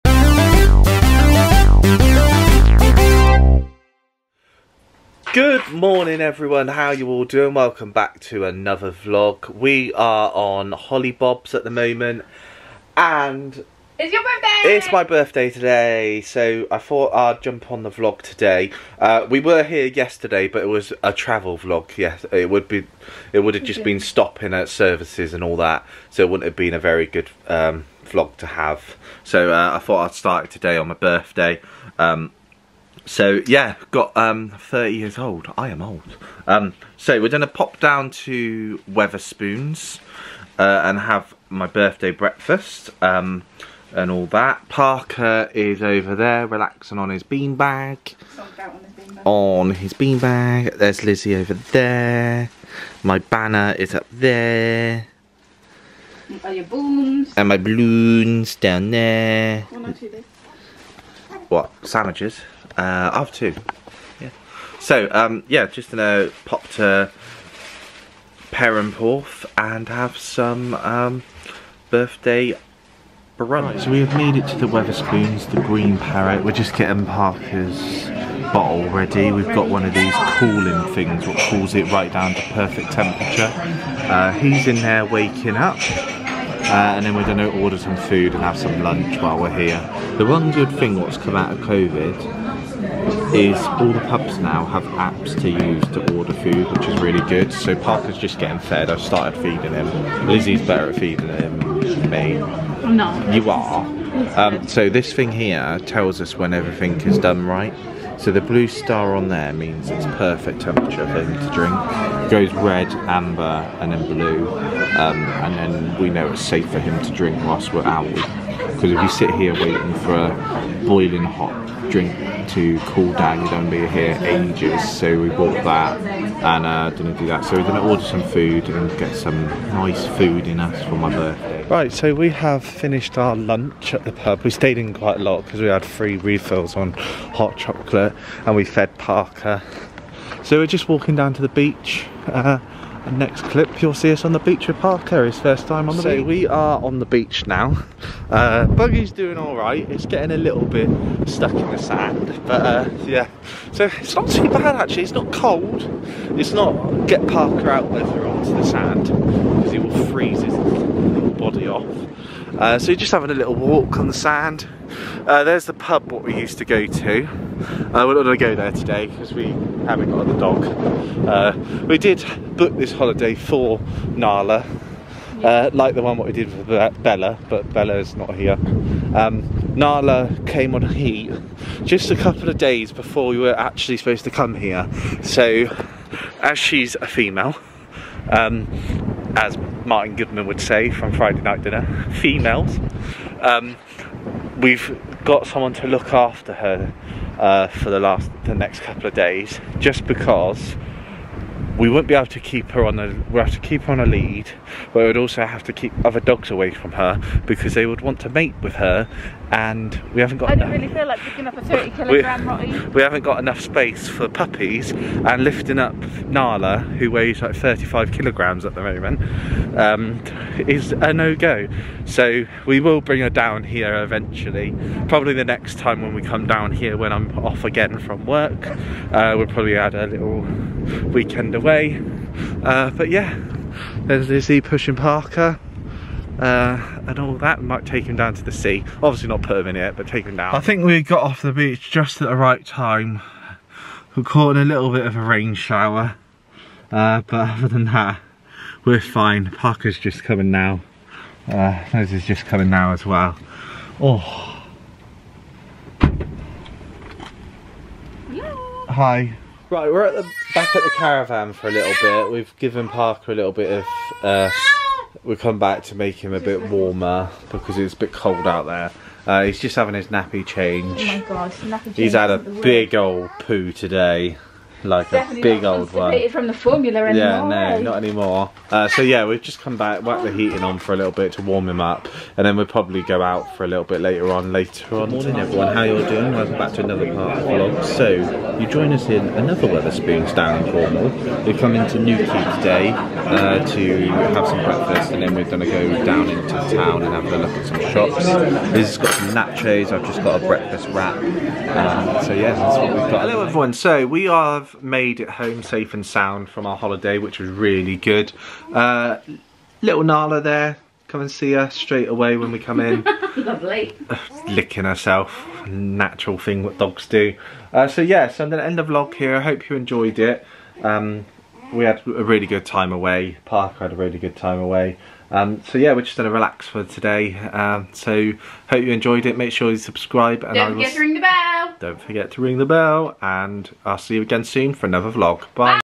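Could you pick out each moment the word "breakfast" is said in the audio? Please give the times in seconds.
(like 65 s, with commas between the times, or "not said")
42 s, 294 s, 300 s.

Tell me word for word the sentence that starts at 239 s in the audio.
Obviously not put him in it, but take him down.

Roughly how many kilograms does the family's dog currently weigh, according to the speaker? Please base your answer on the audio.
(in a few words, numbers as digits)
35.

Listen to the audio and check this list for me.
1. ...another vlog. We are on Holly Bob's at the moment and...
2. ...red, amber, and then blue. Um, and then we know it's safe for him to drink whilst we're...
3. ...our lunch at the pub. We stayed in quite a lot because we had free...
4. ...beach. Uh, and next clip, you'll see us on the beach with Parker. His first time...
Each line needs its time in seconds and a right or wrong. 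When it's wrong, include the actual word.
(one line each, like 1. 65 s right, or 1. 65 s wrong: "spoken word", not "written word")
1. 8 s right
2. 112 s right
3. 133 s right
4. 141 s right.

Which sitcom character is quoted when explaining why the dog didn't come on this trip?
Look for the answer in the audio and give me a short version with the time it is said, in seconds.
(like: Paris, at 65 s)
Martin Goodman, at 189 s.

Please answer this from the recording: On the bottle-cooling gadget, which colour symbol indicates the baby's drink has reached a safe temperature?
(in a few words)
Blue star.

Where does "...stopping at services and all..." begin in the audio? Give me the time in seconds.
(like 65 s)
24 s.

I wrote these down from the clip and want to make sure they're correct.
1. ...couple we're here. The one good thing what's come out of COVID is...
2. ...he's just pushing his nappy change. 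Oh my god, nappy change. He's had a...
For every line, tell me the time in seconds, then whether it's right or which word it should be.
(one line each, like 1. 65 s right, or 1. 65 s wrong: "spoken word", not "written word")
1. 89 s wrong: "while", not "couple"
2. 269 s wrong: "having", not "pushing".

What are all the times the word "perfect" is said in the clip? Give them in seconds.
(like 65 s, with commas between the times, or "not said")
82 s, 110 s.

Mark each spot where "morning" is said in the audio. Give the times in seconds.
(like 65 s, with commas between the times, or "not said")
5 s, 285 s.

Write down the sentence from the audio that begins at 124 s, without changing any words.
So we bought that and uh, didn't do that.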